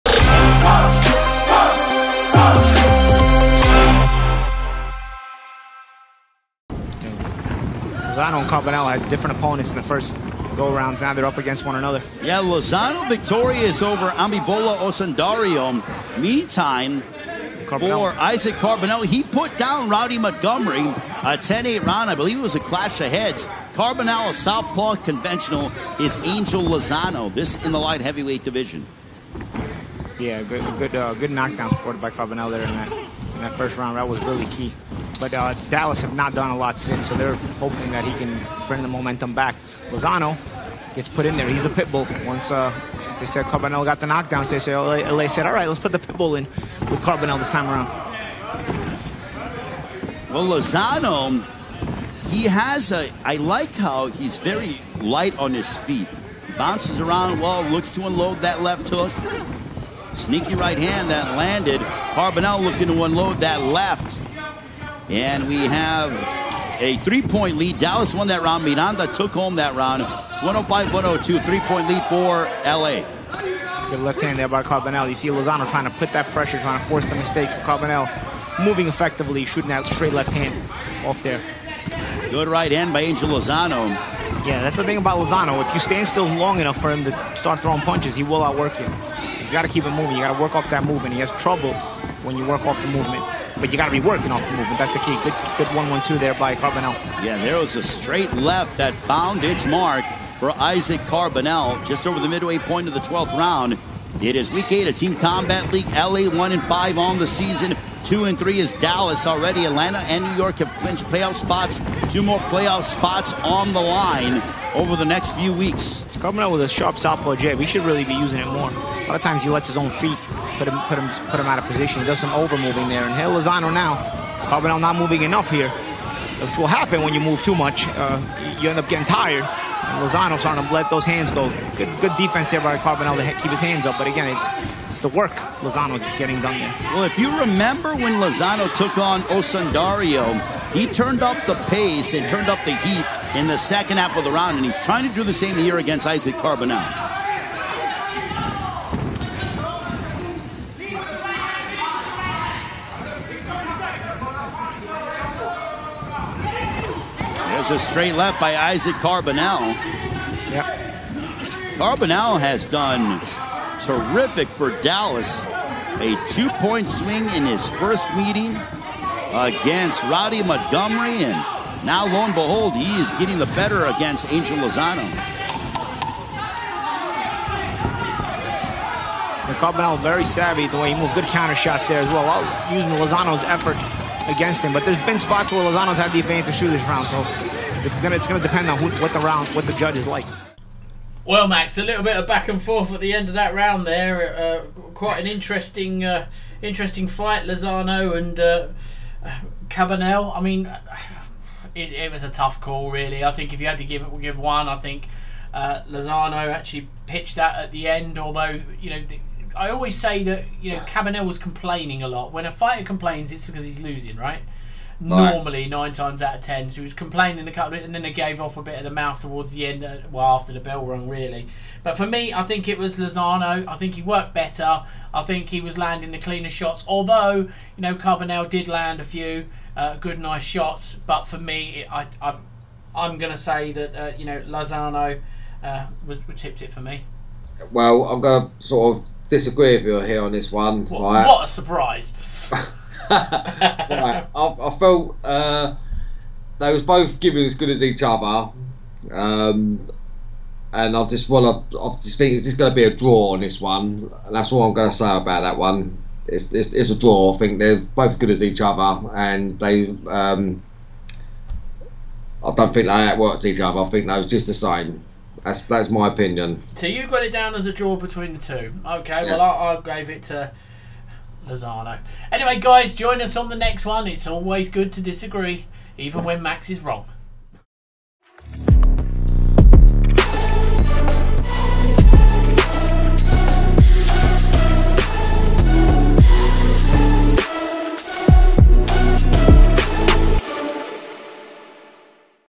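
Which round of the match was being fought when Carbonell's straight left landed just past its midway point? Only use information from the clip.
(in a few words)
12th round.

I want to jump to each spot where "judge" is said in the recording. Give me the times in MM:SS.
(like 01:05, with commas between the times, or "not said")
03:09.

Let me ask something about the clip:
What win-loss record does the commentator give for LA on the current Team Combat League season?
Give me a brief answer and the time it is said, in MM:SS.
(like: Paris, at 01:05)
1 and 5, at 01:46.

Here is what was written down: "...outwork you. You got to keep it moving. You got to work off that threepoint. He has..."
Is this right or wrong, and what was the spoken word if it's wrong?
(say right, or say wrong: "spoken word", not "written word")
wrong: "movement", not "threepoint".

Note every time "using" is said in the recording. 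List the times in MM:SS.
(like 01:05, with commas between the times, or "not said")
01:58, 03:02.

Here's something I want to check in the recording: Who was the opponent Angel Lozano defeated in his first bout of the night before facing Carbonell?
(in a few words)
Abimbola Osundairo.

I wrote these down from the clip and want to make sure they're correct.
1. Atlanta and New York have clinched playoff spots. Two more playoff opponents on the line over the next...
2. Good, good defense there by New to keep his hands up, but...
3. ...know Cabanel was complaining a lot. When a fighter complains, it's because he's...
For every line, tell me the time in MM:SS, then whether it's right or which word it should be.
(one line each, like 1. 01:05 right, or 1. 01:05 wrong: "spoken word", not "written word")
1. 01:49 wrong: "spots", not "opponents"
2. 02:11 wrong: "Carbonell", not "New"
3. 03:30 right.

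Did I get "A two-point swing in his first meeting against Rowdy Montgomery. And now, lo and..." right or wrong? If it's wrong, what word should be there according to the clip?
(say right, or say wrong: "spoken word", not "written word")
right.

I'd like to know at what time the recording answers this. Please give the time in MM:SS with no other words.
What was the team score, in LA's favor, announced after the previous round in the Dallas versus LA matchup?
01:10.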